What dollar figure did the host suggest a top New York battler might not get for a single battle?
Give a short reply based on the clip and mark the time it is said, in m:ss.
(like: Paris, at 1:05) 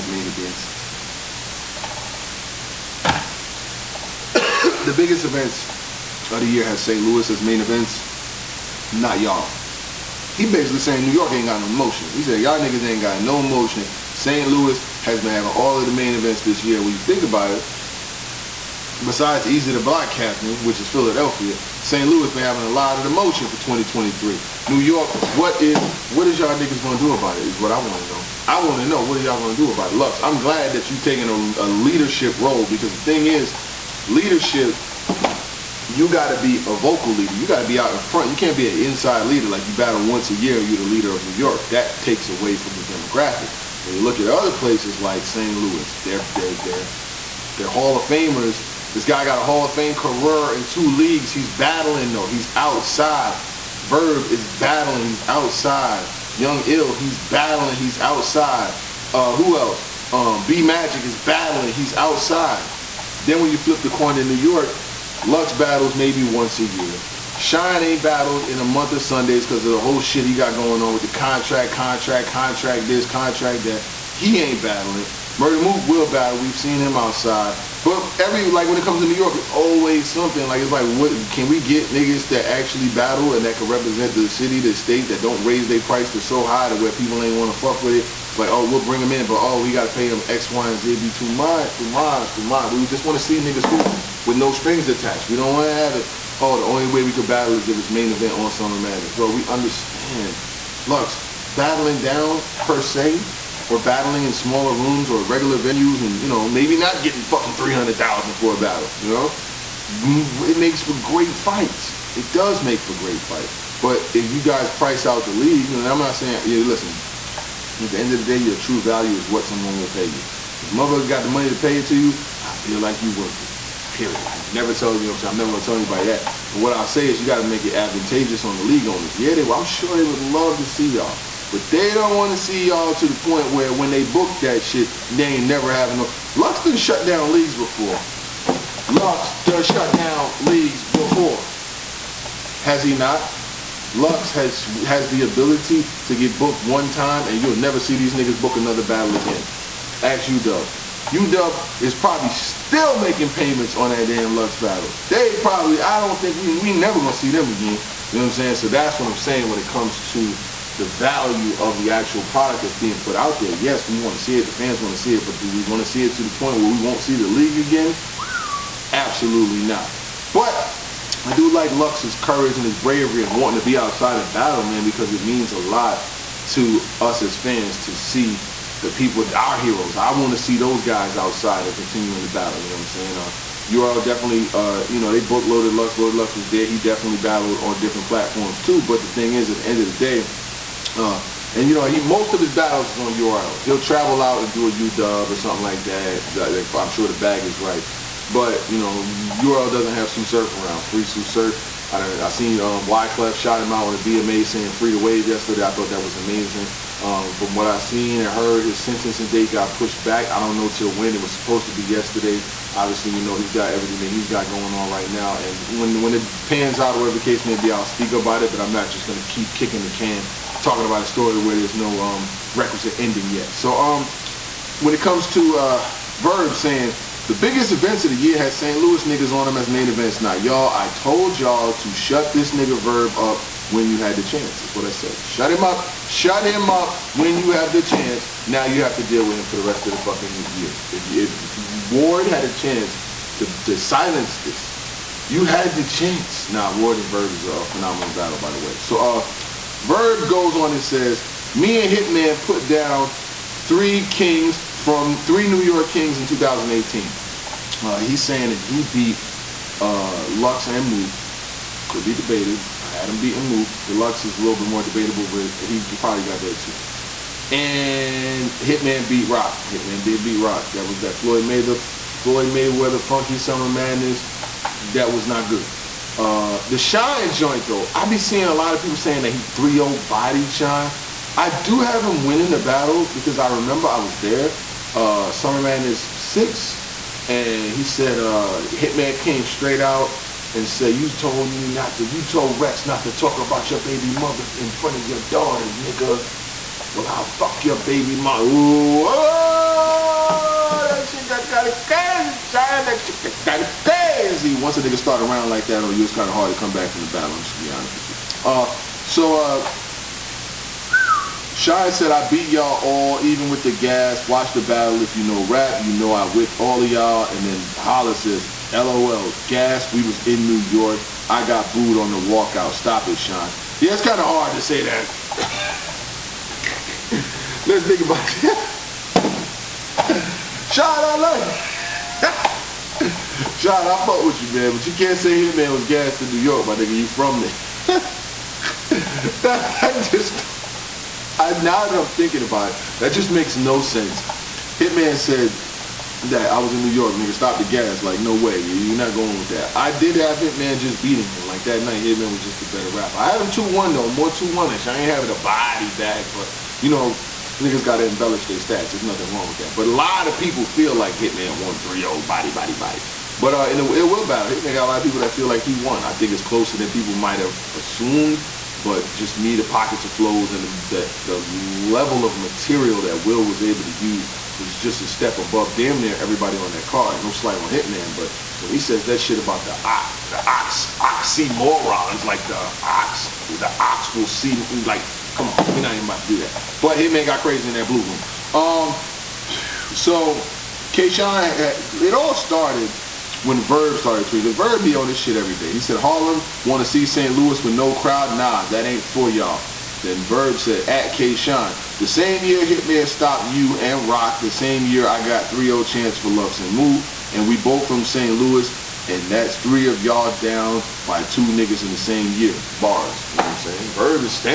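300000, at 1:47.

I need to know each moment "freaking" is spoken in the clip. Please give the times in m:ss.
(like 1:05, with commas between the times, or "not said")
not said.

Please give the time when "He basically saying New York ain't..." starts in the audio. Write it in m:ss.
0:10.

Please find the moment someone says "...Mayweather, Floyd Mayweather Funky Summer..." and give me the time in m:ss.
4:31.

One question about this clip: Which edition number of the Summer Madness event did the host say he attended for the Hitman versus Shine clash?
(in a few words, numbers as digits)
6.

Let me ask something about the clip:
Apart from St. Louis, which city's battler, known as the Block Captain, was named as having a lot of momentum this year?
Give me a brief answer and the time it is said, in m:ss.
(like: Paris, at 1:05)
Philadelphia, at 0:20.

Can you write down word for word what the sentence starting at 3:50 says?
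Now, y'all, I told y'all to shut this nigga Verb up when you had the chance.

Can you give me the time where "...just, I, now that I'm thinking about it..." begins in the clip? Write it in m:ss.
5:40.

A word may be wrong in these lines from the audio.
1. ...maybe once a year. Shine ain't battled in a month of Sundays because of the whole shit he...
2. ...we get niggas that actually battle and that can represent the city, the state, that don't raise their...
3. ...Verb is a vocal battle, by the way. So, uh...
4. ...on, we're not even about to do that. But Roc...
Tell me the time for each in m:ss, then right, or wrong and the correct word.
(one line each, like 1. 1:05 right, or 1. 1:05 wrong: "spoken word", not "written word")
1. 1:05 right
2. 1:21 right
3. 4:07 wrong: "phenomenal", not "vocal"
4. 6:25 wrong: "Hitman", not "Roc".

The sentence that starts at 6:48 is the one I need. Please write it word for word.
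Louis, and that's three of y'all down by two niggas in the same year.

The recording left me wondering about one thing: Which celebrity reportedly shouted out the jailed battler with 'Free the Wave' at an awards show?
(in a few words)
Wyclef.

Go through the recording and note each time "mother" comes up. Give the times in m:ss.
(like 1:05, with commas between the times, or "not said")
2:00, 4:54, 4:58.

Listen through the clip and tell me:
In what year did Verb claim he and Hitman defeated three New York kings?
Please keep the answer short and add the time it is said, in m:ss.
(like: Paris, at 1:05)
2018, at 4:16.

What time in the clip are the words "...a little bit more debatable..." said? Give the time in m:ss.
4:24.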